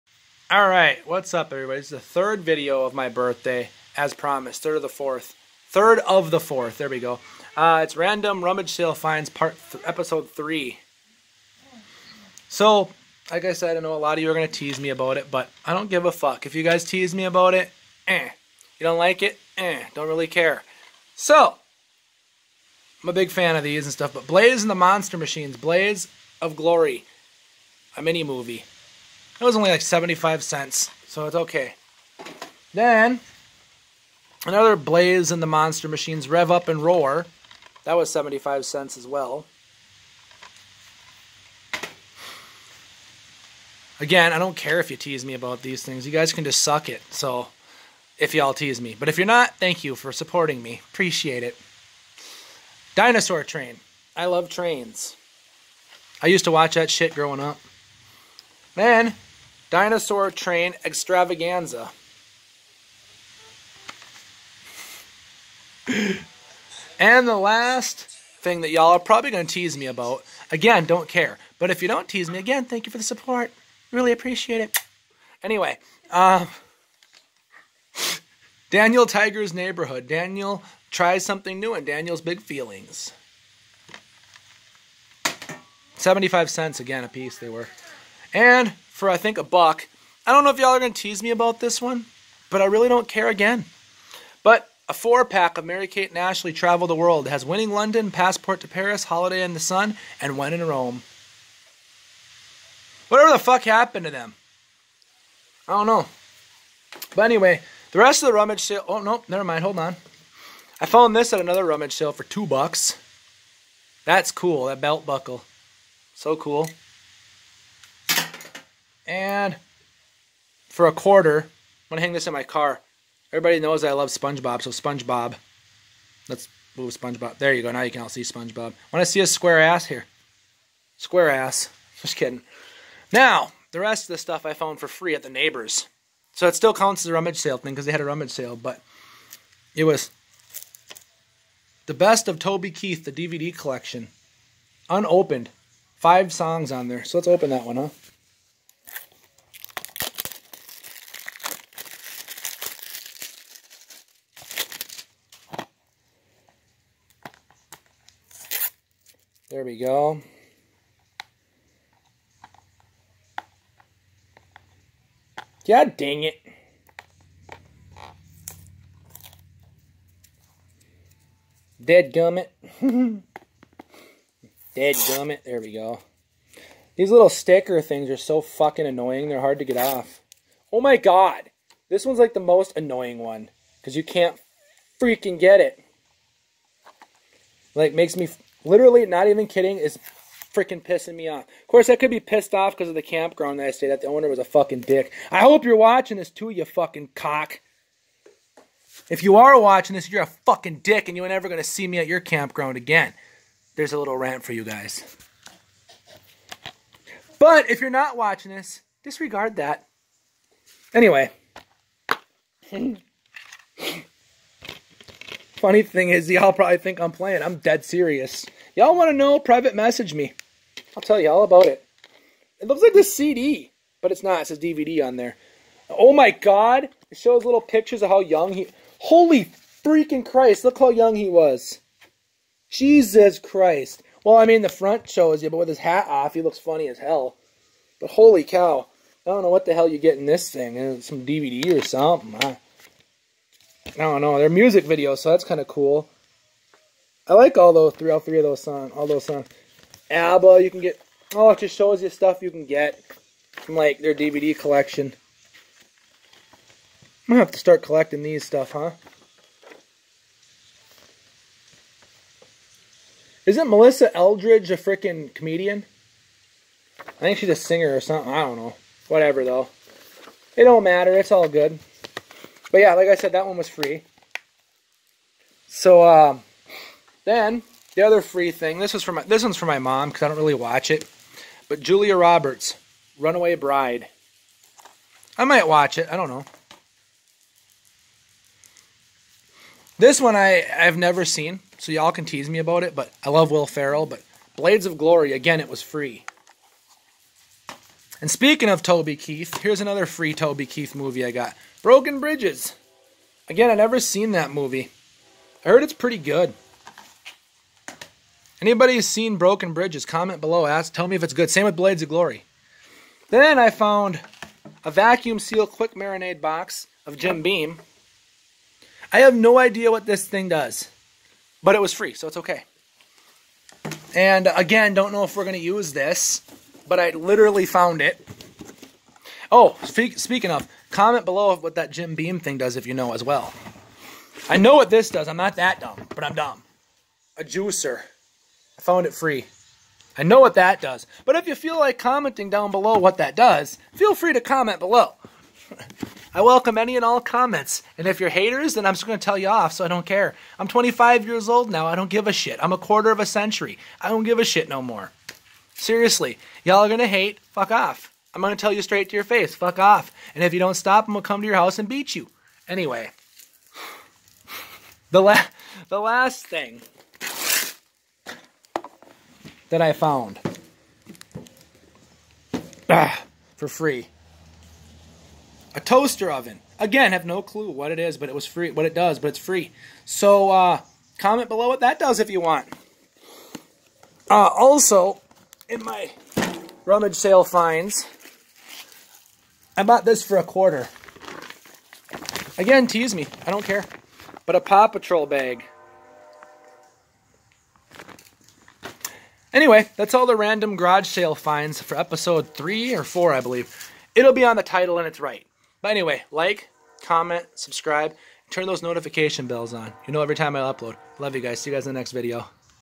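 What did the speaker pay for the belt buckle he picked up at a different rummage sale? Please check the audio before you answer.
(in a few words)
2 bucks.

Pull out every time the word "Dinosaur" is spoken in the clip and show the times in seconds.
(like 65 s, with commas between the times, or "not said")
52 s, 59 s.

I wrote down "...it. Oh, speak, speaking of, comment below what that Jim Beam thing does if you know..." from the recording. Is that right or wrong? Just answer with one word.
right.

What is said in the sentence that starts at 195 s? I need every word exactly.
I hope you're watching this too, you fucking cock.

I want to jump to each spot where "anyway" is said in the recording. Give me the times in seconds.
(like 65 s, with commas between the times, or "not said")
75 s, 107 s, 210 s, 362 s, 399 s, 405 s.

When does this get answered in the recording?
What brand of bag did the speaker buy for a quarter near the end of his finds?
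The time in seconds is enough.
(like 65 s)
394 s.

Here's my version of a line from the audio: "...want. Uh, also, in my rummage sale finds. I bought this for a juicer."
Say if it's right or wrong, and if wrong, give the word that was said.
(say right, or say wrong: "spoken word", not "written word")
wrong: "quarter", not "juicer".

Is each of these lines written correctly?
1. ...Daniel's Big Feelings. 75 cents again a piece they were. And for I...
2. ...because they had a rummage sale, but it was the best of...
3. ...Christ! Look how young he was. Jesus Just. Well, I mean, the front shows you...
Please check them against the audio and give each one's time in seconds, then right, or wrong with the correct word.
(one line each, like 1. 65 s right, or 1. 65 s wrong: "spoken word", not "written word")
1. 81 s right
2. 137 s right
3. 230 s wrong: "Christ", not "Just".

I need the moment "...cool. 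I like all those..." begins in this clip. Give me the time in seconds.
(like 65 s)
245 s.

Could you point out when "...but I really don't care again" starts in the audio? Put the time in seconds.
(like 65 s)
92 s.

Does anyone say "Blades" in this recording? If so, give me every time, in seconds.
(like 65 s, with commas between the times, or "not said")
294 s, 311 s.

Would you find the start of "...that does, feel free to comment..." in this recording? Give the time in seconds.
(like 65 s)
343 s.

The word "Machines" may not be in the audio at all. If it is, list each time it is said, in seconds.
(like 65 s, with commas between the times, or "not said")
25 s, 35 s.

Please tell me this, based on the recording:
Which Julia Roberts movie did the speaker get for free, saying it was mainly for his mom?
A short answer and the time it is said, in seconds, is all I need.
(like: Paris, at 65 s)
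Runaway Bride, at 283 s.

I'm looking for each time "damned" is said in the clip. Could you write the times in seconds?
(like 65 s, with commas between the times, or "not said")
not said.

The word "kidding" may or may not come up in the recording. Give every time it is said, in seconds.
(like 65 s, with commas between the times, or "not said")
132 s, 189 s.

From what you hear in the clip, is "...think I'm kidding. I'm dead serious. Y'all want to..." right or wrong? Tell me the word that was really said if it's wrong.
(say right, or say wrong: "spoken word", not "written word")
wrong: "playing", not "kidding".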